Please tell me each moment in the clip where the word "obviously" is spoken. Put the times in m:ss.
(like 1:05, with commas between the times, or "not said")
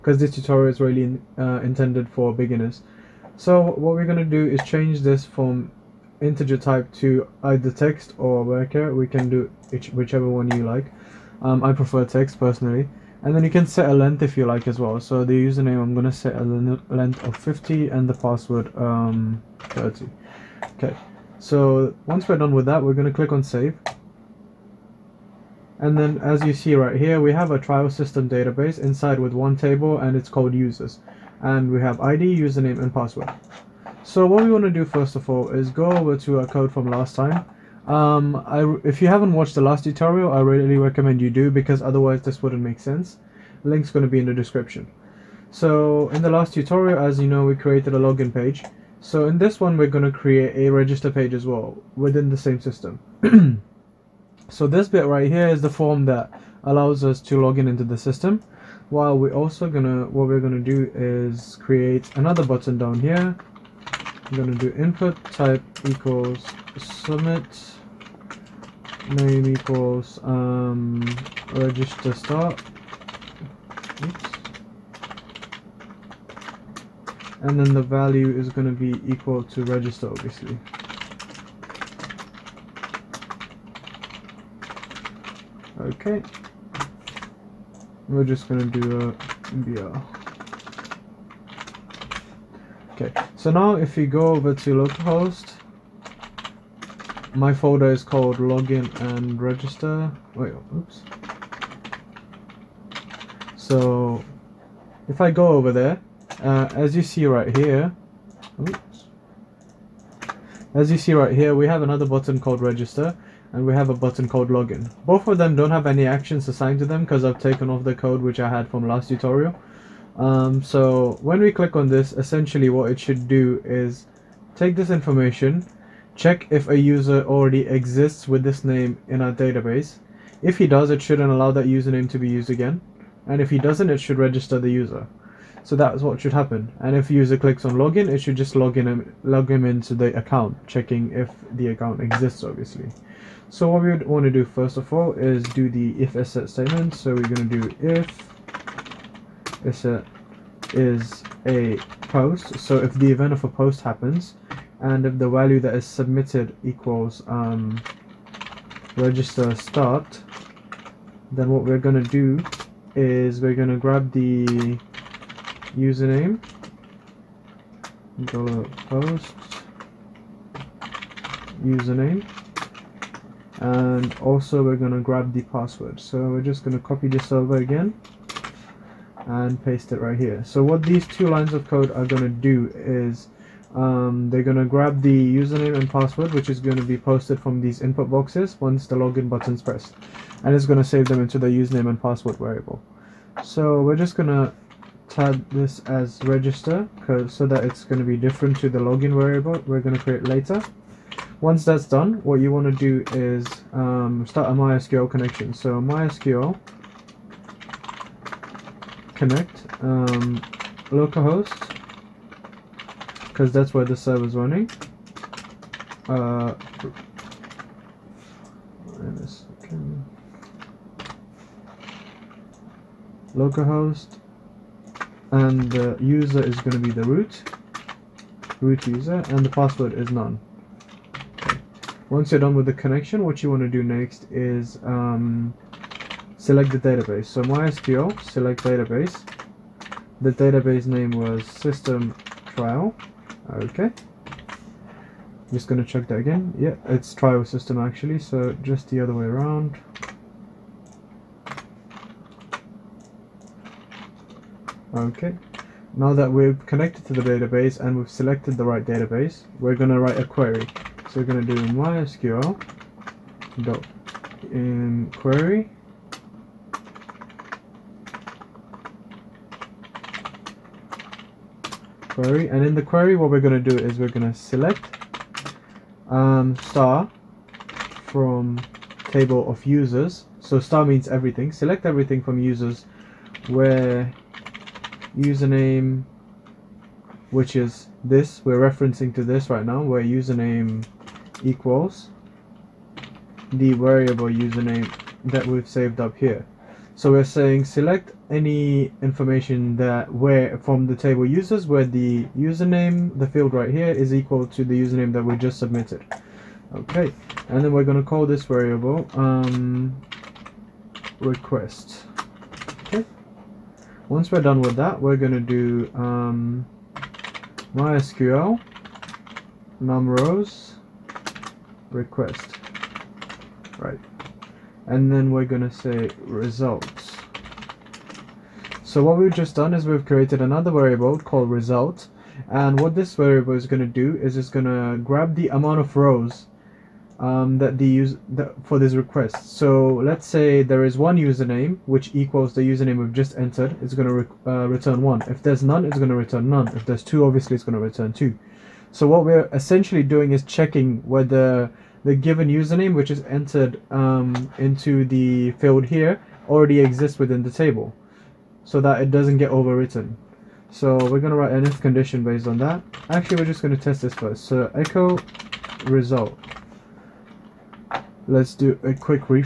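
1:20, 2:22, 5:47.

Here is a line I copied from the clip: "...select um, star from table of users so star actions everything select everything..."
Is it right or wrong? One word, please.
wrong.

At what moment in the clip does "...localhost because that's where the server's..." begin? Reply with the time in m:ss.
3:30.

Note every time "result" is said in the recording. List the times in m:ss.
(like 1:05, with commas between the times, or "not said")
5:26, 5:31, 6:05.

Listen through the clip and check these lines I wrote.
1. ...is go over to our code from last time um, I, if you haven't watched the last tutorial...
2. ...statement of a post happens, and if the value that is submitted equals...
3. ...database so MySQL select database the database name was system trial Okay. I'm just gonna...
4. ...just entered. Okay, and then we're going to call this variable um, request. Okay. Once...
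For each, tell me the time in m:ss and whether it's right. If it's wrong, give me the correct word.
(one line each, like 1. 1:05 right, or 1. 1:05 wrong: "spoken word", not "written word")
1. 0:35 right
2. 2:33 wrong: "event", not "statement"
3. 3:56 right
4. 5:05 wrong: "submitted", not "entered".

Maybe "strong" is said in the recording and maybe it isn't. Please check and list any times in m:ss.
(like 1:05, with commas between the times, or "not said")
not said.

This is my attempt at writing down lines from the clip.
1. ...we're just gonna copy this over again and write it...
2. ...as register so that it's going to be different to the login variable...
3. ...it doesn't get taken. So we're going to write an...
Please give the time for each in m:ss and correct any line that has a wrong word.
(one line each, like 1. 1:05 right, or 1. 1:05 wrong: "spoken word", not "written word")
1. 2:56 wrong: "paste", not "write"
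2. 3:15 right
3. 5:59 wrong: "overwritten", not "taken".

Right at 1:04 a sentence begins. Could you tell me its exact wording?
I'm gonna do input type equals submit name equals um, register oh, start.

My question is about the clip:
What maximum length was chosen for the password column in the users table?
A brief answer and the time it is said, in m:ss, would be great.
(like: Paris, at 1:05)
30, at 0:19.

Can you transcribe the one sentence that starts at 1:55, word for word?
Both of them don't have any actions assigned to them because I've taken off the code which I had from last tutorial.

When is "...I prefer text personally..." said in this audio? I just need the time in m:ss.
0:11.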